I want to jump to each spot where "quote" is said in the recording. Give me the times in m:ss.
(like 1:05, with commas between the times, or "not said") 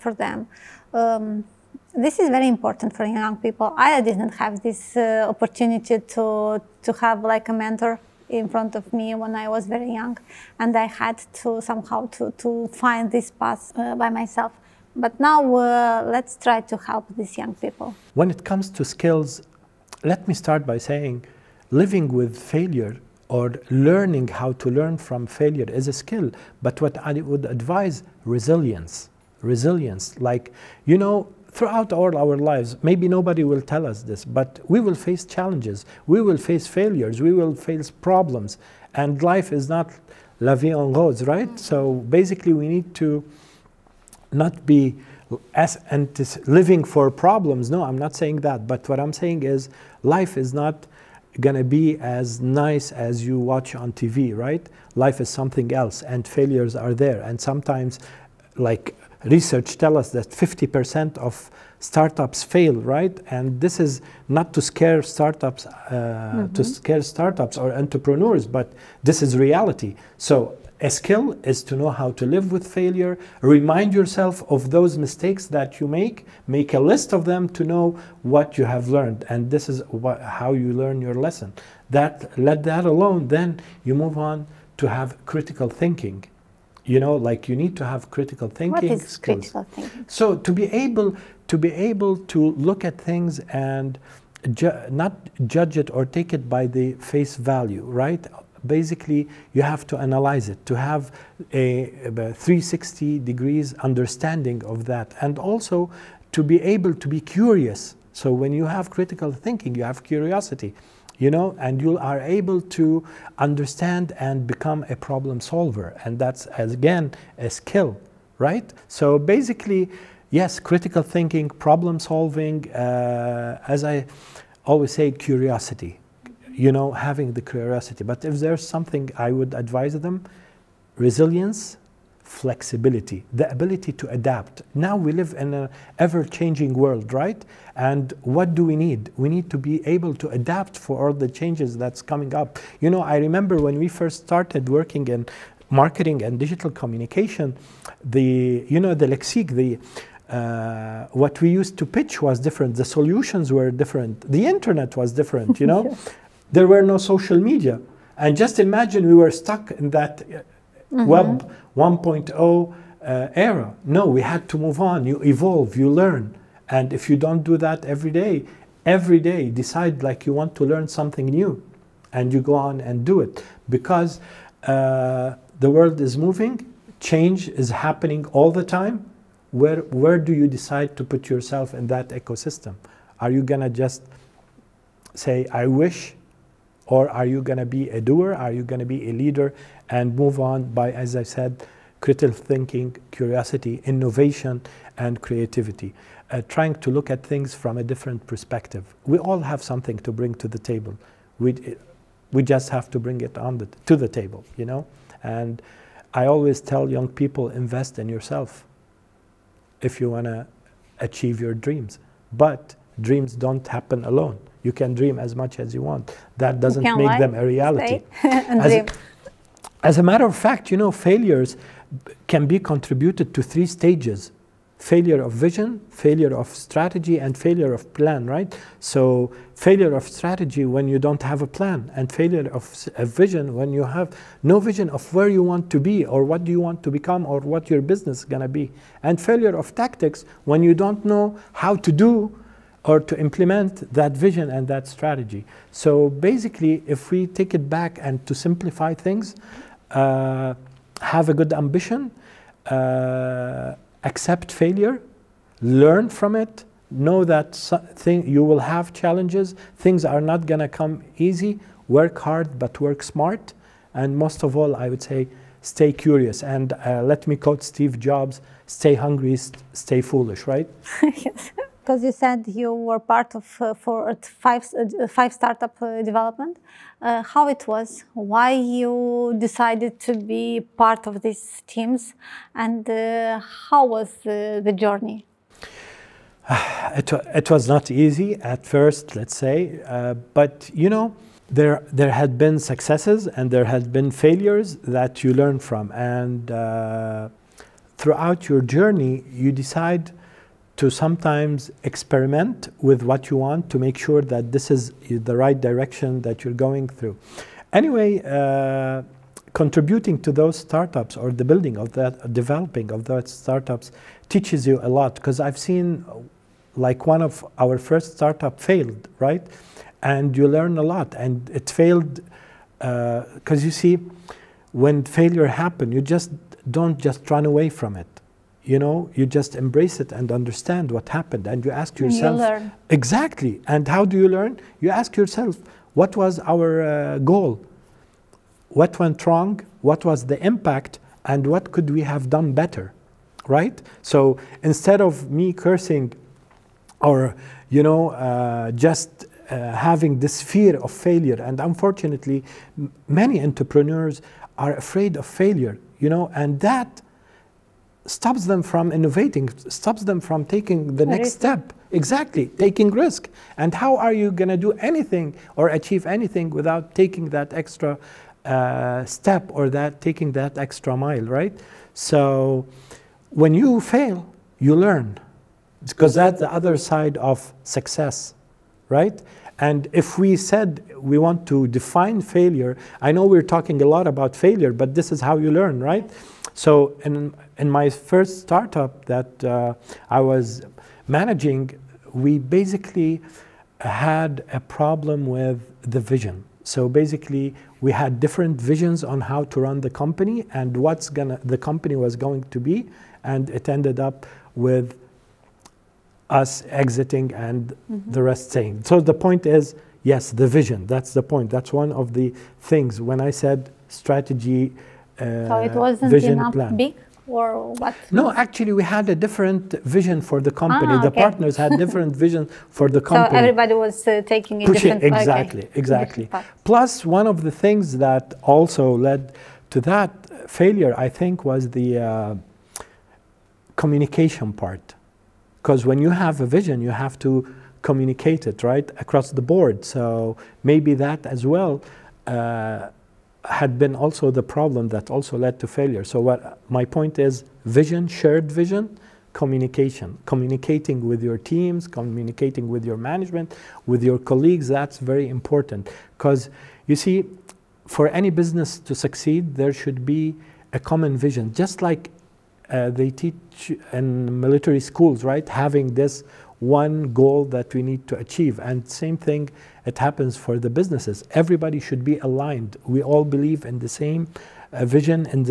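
4:27.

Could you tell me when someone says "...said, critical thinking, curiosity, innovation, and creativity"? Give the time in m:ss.
3:11.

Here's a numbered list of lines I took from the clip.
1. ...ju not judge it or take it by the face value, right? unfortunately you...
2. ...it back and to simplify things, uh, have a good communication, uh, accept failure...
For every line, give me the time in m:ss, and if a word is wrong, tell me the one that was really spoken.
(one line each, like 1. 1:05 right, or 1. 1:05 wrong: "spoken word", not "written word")
1. 1:34 wrong: "basically", not "unfortunately"
2. 4:07 wrong: "ambition", not "communication".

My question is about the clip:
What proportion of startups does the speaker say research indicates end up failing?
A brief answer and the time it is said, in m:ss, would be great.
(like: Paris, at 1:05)
50%, at 1:00.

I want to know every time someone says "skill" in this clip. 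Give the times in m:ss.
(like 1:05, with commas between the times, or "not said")
0:18, 0:25, 1:10, 1:29, 1:57.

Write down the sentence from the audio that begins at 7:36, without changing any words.
Because you see, for any business to succeed, there should be a common vision.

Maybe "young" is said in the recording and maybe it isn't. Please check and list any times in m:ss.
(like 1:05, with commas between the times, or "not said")
0:03, 0:09, 0:17, 3:26.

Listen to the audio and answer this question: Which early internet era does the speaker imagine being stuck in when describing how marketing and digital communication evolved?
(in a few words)
web 1.0.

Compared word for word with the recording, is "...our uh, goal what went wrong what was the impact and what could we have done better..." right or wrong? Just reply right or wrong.
right.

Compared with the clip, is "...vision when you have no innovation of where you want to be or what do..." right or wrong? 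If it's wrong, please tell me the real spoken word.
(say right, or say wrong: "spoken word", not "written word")
wrong: "vision", not "innovation".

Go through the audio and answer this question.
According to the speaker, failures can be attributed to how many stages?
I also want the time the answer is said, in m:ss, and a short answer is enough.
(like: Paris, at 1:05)
3, at 3:43.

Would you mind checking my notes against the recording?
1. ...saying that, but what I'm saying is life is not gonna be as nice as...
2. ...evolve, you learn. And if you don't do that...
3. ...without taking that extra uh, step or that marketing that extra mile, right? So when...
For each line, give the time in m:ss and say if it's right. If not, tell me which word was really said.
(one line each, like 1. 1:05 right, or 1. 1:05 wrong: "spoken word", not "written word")
1. 0:48 right
2. 2:45 right
3. 6:06 wrong: "taking", not "marketing".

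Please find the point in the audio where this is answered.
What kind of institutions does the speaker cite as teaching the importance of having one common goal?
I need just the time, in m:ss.
7:44.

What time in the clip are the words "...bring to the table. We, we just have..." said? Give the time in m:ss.
3:20.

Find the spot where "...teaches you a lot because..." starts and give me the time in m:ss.
5:14.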